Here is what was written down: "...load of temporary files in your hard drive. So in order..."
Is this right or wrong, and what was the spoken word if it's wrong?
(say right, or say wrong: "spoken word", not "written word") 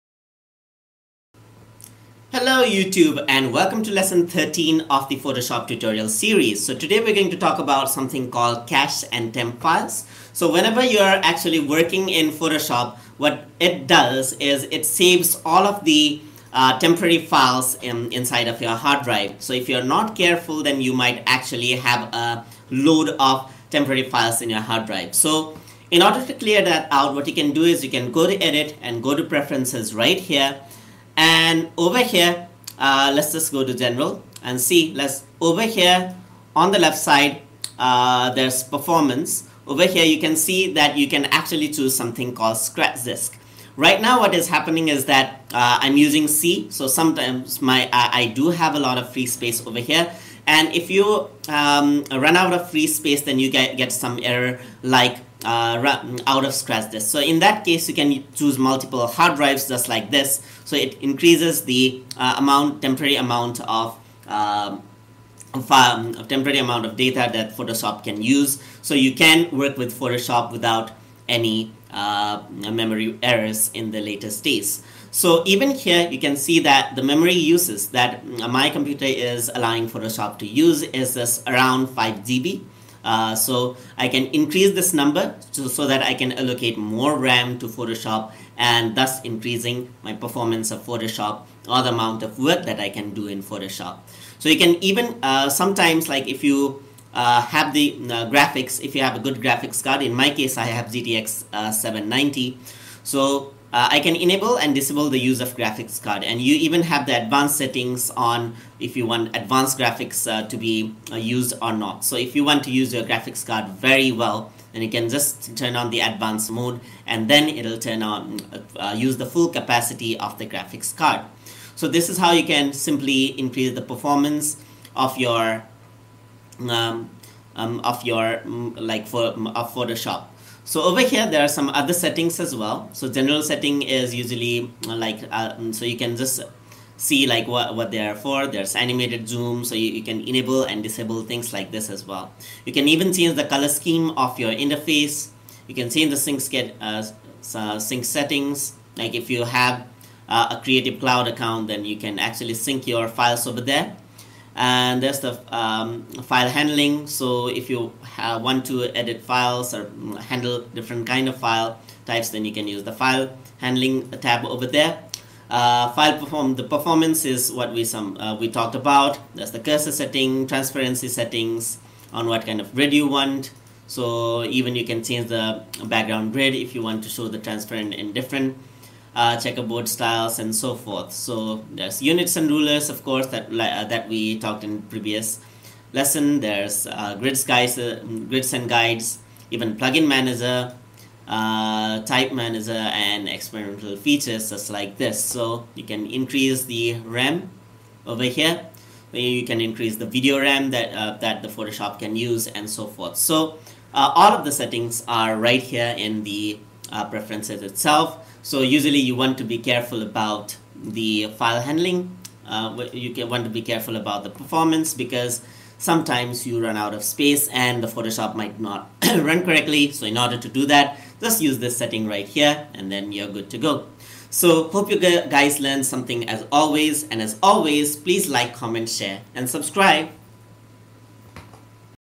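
right.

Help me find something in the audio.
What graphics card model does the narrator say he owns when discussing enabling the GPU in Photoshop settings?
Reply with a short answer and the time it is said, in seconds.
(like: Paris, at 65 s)
GTX 790, at 100 s.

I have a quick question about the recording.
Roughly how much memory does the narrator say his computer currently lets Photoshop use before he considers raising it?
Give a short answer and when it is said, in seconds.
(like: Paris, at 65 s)
5 GB, at 81 s.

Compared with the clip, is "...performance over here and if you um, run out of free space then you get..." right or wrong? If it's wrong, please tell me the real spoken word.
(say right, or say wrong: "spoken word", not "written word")
wrong: "space", not "performance".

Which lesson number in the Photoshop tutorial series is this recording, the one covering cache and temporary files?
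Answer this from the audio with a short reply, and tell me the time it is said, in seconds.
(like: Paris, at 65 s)
13, at 3 s.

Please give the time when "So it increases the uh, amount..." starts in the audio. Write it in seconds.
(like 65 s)
60 s.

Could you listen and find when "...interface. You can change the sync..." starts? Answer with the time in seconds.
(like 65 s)
144 s.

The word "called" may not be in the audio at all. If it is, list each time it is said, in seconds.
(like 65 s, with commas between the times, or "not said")
8 s, 42 s.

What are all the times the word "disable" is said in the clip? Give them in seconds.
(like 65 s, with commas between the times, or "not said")
104 s, 140 s.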